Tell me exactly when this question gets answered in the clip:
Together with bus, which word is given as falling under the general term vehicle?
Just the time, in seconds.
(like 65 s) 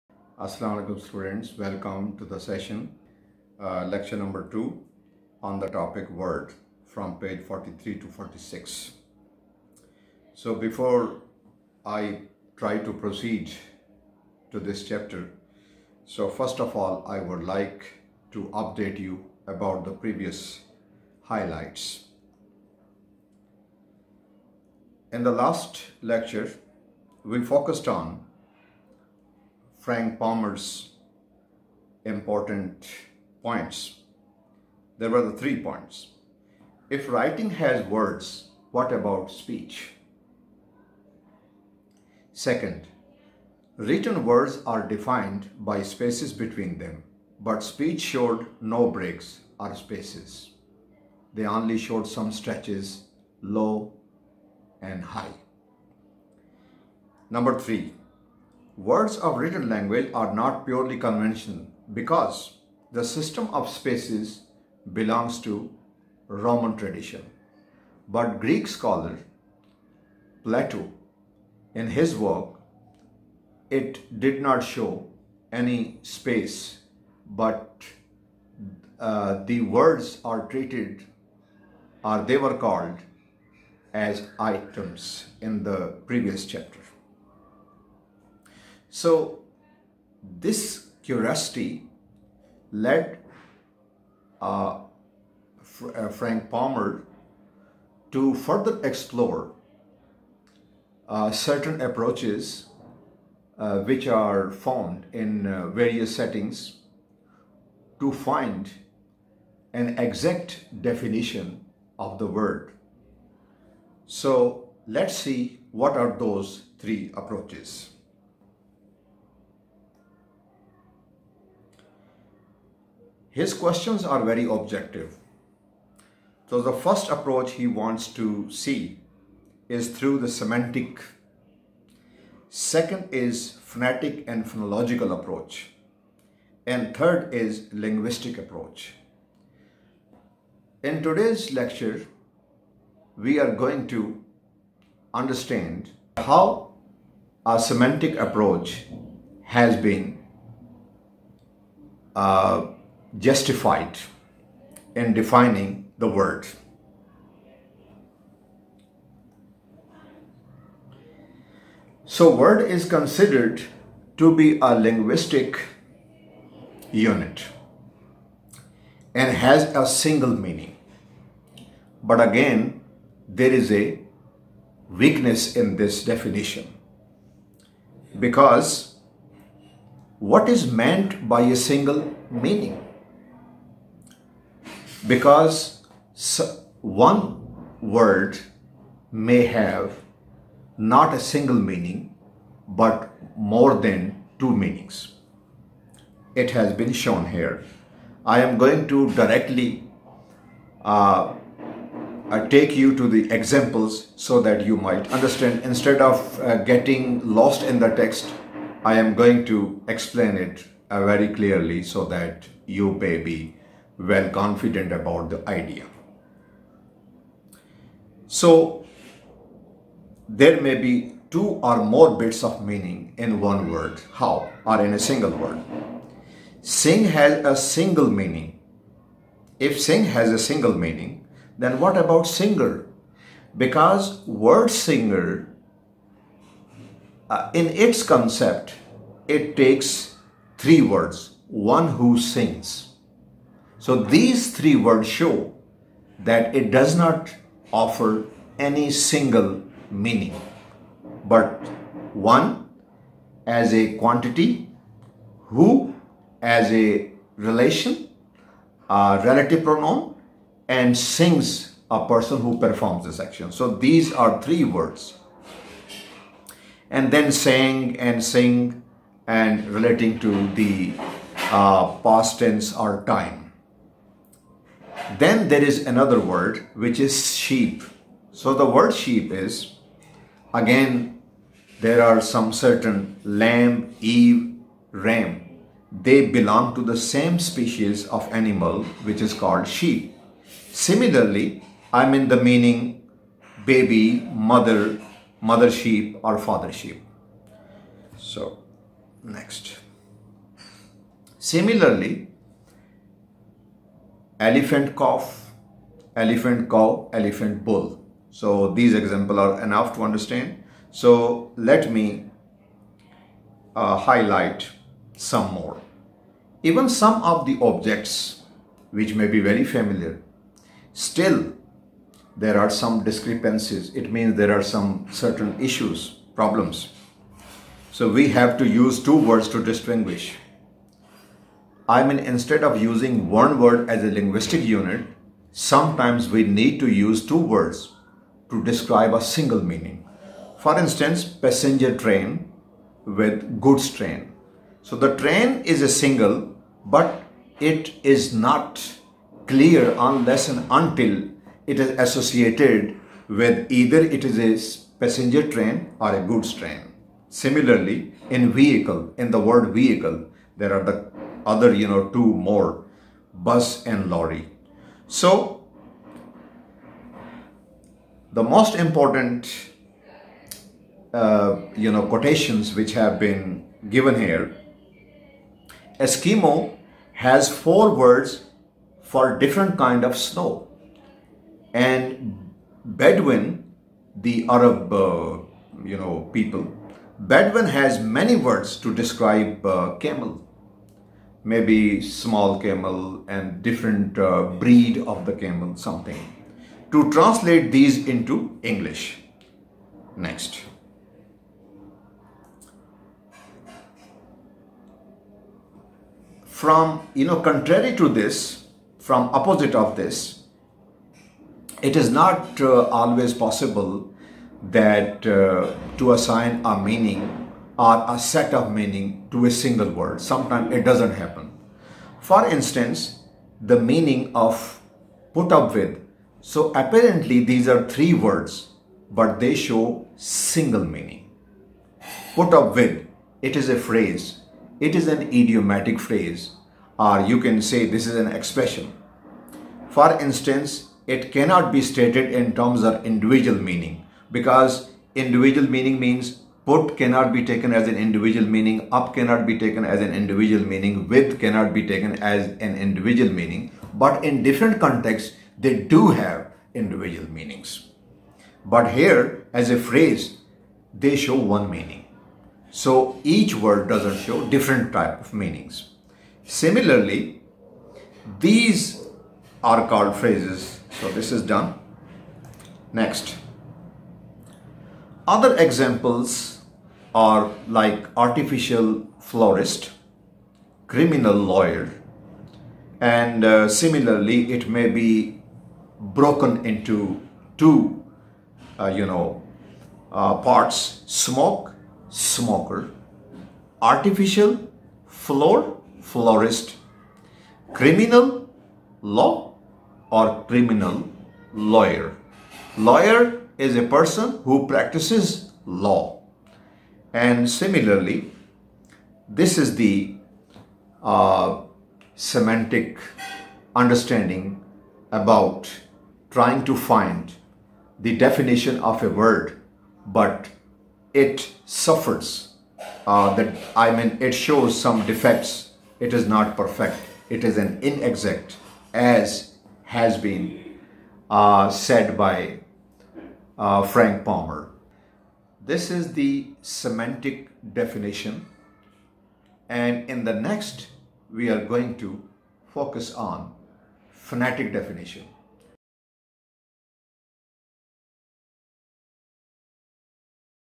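364 s.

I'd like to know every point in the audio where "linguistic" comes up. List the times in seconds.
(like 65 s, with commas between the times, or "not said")
137 s, 164 s, 334 s.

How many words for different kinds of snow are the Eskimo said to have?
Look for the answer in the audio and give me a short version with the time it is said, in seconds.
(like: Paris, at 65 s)
4, at 377 s.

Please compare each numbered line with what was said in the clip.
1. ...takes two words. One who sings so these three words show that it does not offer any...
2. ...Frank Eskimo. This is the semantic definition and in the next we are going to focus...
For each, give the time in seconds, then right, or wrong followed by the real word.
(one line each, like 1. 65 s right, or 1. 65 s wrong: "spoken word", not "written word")
1. 239 s wrong: "three", not "two"
2. 533 s wrong: "Palmer", not "Eskimo".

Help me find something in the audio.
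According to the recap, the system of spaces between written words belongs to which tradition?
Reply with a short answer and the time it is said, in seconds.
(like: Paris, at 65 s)
Roman tradition, at 66 s.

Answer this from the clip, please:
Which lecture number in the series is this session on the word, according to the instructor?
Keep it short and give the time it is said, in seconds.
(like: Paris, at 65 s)
2, at 3 s.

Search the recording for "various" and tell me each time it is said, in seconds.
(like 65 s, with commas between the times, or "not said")
105 s.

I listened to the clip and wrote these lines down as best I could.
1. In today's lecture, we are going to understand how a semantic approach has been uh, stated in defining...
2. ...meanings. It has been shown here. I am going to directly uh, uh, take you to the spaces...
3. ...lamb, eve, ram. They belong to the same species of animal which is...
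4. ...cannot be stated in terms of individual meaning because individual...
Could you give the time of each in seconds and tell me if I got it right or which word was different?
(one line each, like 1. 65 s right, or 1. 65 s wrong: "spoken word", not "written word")
1. 140 s wrong: "justified", not "stated"
2. 194 s wrong: "examples", not "spaces"
3. 283 s right
4. 441 s right.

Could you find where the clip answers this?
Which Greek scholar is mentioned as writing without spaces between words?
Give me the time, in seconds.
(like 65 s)
70 s.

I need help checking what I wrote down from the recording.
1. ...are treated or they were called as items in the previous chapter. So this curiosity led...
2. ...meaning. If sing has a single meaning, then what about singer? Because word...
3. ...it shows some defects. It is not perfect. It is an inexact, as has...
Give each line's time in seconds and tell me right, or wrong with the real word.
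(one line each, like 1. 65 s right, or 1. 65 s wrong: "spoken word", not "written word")
1. 80 s right
2. 228 s right
3. 524 s right.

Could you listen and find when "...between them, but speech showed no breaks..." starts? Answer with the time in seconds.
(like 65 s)
46 s.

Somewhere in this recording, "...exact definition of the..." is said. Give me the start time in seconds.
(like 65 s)
109 s.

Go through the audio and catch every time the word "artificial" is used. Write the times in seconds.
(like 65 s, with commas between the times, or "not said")
478 s, 493 s.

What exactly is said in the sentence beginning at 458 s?
But here, as a phrase, they show one meaning.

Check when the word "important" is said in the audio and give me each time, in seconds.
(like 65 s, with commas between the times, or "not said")
32 s, 368 s.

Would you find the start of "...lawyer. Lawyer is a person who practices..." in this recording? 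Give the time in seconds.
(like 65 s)
501 s.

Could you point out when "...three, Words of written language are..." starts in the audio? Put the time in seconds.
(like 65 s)
57 s.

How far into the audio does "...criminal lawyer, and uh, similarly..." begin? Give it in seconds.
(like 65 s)
480 s.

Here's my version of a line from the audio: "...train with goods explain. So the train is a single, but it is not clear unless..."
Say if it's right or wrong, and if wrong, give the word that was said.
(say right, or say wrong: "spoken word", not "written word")
wrong: "train", not "explain".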